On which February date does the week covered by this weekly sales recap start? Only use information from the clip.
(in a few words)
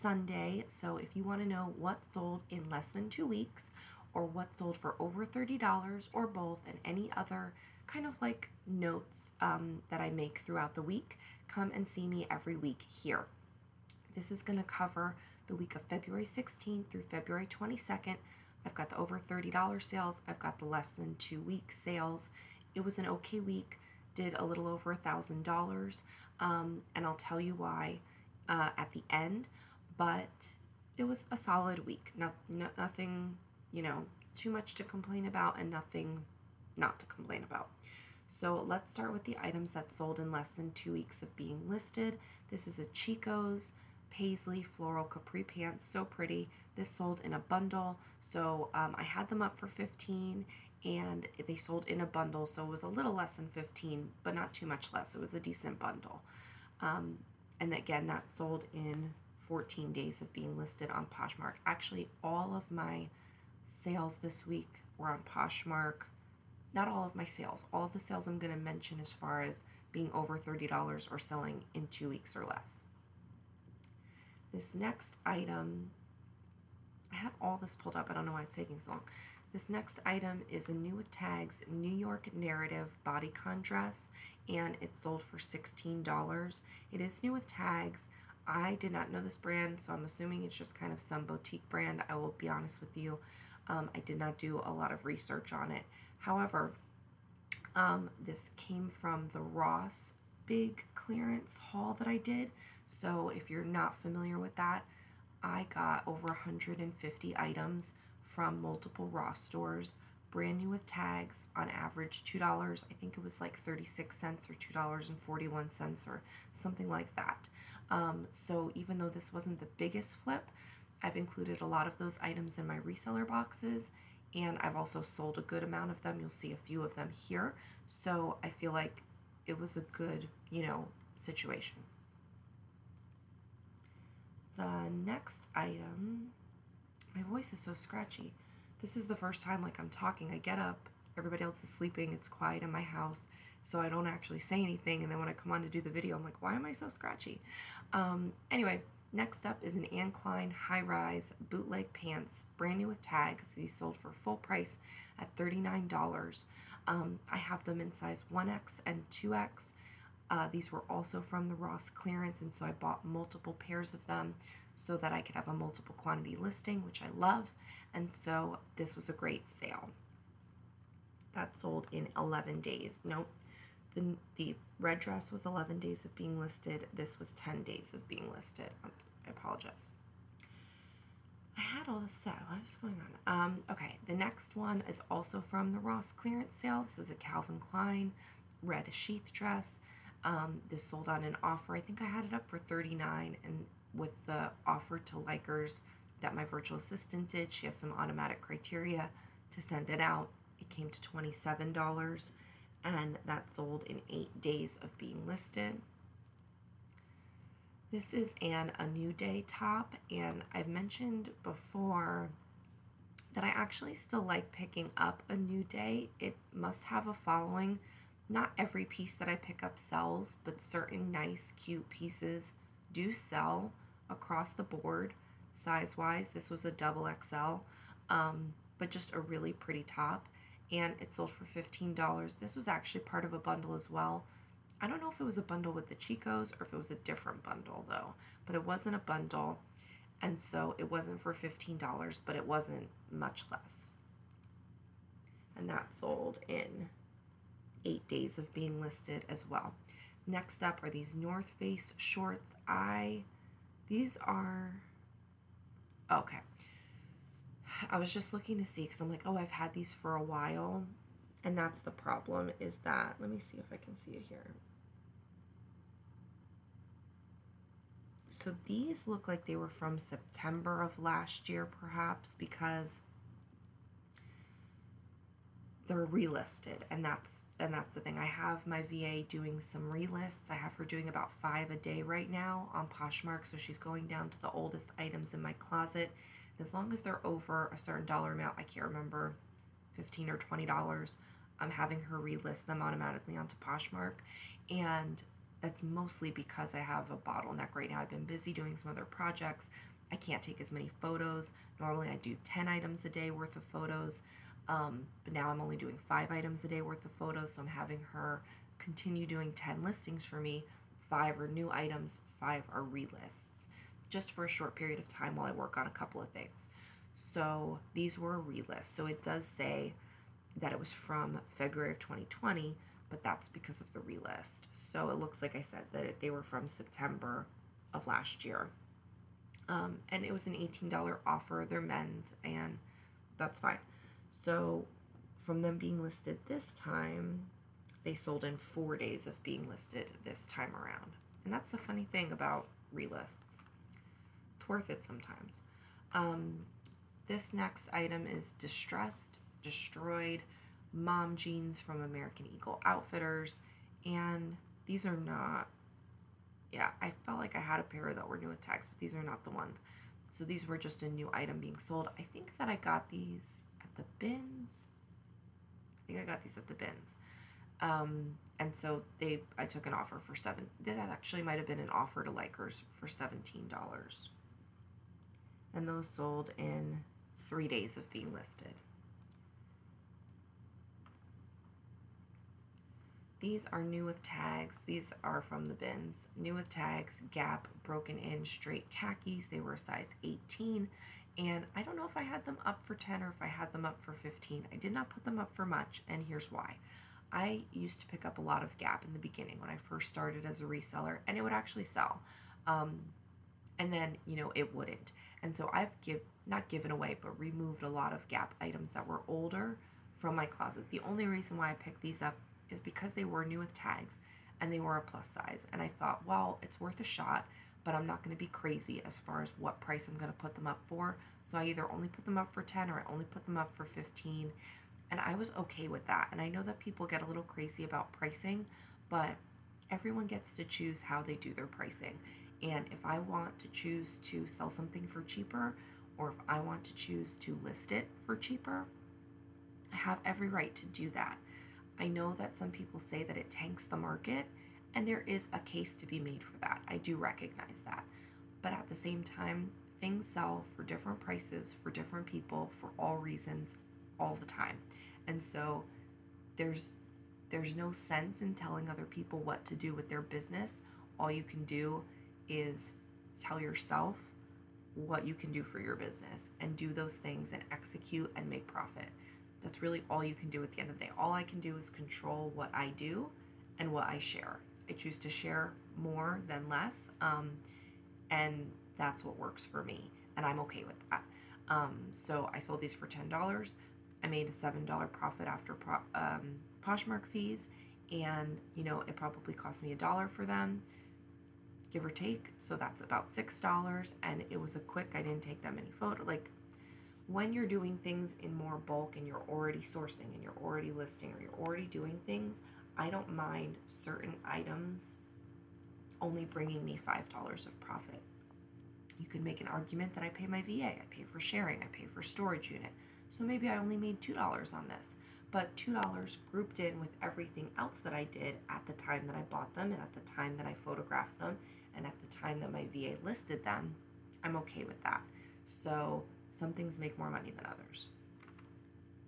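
February 16th.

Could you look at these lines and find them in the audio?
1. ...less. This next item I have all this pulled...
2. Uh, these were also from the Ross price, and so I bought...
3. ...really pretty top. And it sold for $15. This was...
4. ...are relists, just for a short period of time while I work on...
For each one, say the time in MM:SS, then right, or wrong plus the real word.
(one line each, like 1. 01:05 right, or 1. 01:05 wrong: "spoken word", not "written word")
1. 01:12 right
2. 02:40 wrong: "clearance", not "price"
3. 03:49 right
4. 05:12 right.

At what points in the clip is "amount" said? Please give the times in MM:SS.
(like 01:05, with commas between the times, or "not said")
02:05, 04:48.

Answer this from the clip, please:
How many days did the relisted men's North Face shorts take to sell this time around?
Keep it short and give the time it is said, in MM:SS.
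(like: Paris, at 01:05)
4, at 05:38.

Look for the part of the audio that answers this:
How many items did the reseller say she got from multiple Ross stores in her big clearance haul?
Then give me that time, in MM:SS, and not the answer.
01:46.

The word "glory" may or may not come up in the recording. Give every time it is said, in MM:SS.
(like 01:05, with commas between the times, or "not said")
not said.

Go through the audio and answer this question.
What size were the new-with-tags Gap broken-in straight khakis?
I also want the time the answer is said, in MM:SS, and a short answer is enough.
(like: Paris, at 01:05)
18, at 06:29.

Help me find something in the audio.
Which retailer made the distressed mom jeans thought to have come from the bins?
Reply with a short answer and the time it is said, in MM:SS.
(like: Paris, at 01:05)
American Eagle Outfitters, at 05:52.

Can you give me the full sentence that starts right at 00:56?
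Um, and again, that sold in 14 days of being listed on Poshmark.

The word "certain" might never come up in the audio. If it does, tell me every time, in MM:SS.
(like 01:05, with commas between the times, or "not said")
03:40, 04:47, 08:23.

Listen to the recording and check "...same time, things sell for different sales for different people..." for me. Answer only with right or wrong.
wrong.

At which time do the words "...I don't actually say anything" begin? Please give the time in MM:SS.
02:23.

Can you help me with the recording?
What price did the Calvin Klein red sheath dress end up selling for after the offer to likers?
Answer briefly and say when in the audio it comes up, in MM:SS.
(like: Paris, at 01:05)
$27, at 03:21.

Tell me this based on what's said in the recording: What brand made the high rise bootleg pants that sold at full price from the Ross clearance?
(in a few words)
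Anne Klein.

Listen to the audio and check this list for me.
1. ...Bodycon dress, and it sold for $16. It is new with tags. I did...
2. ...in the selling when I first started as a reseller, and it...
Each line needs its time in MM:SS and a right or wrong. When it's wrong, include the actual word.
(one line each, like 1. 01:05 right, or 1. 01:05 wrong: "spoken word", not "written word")
1. 01:23 right
2. 06:39 wrong: "beginning", not "selling".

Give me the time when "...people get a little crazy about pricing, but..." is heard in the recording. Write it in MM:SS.
07:06.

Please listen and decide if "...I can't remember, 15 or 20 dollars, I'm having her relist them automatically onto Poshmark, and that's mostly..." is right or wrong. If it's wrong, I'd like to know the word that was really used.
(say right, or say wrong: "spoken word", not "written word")
right.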